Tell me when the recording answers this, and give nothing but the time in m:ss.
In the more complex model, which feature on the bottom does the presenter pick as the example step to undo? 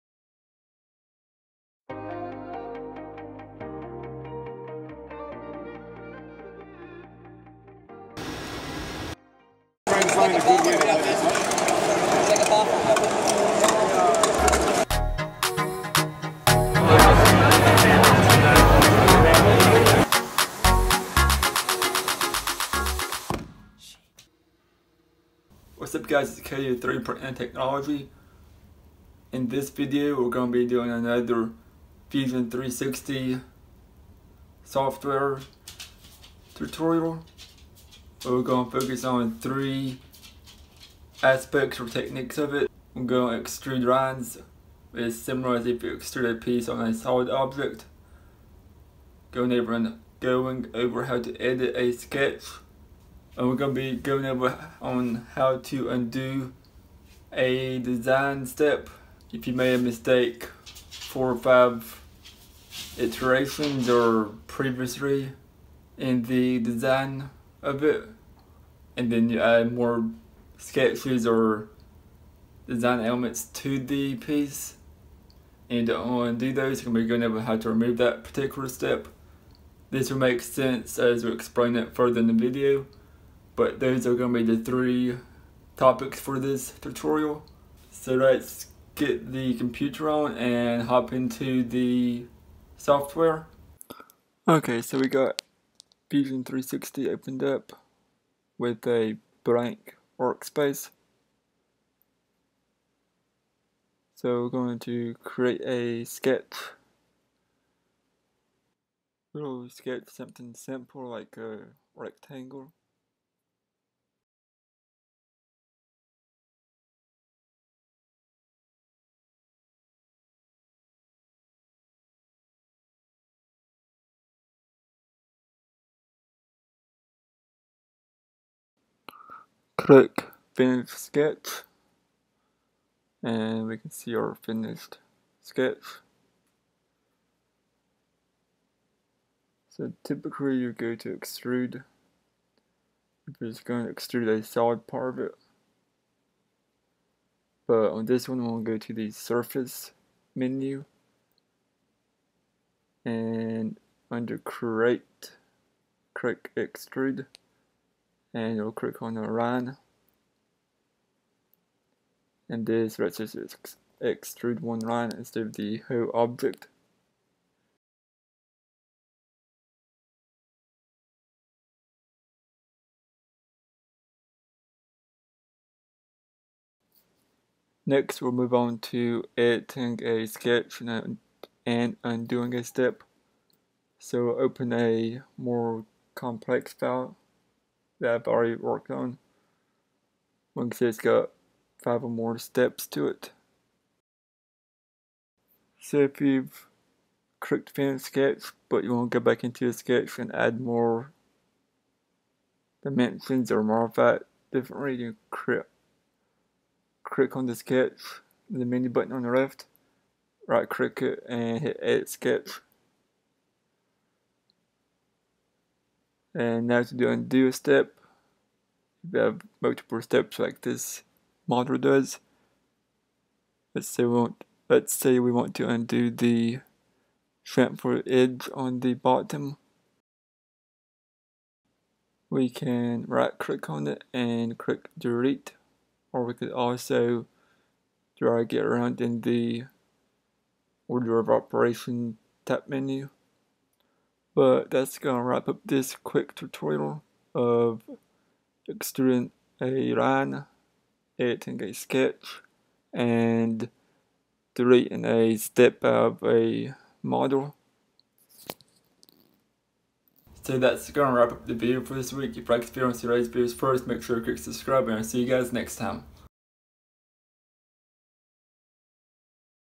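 3:47.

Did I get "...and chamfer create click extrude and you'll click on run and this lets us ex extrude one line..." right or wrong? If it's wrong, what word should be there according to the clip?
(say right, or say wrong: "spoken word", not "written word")
wrong: "under", not "chamfer".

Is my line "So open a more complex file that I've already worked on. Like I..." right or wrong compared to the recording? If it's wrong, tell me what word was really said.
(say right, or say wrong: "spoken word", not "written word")
right.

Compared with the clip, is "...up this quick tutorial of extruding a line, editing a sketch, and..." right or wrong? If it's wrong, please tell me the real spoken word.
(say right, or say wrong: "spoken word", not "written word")
right.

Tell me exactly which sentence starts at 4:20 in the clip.
So that's gonna wrap up the video for this week.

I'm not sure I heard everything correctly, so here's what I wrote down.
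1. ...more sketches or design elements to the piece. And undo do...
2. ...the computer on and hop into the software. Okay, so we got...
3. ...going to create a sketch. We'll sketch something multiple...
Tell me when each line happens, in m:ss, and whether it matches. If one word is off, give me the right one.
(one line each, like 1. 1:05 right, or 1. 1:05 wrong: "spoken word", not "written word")
1. 1:09 right
2. 1:29 right
3. 1:44 wrong: "simple", not "multiple".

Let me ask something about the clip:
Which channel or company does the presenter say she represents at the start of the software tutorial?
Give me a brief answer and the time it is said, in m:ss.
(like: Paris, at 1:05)
3D Print and Technology, at 0:26.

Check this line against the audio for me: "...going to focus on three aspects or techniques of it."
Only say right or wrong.
right.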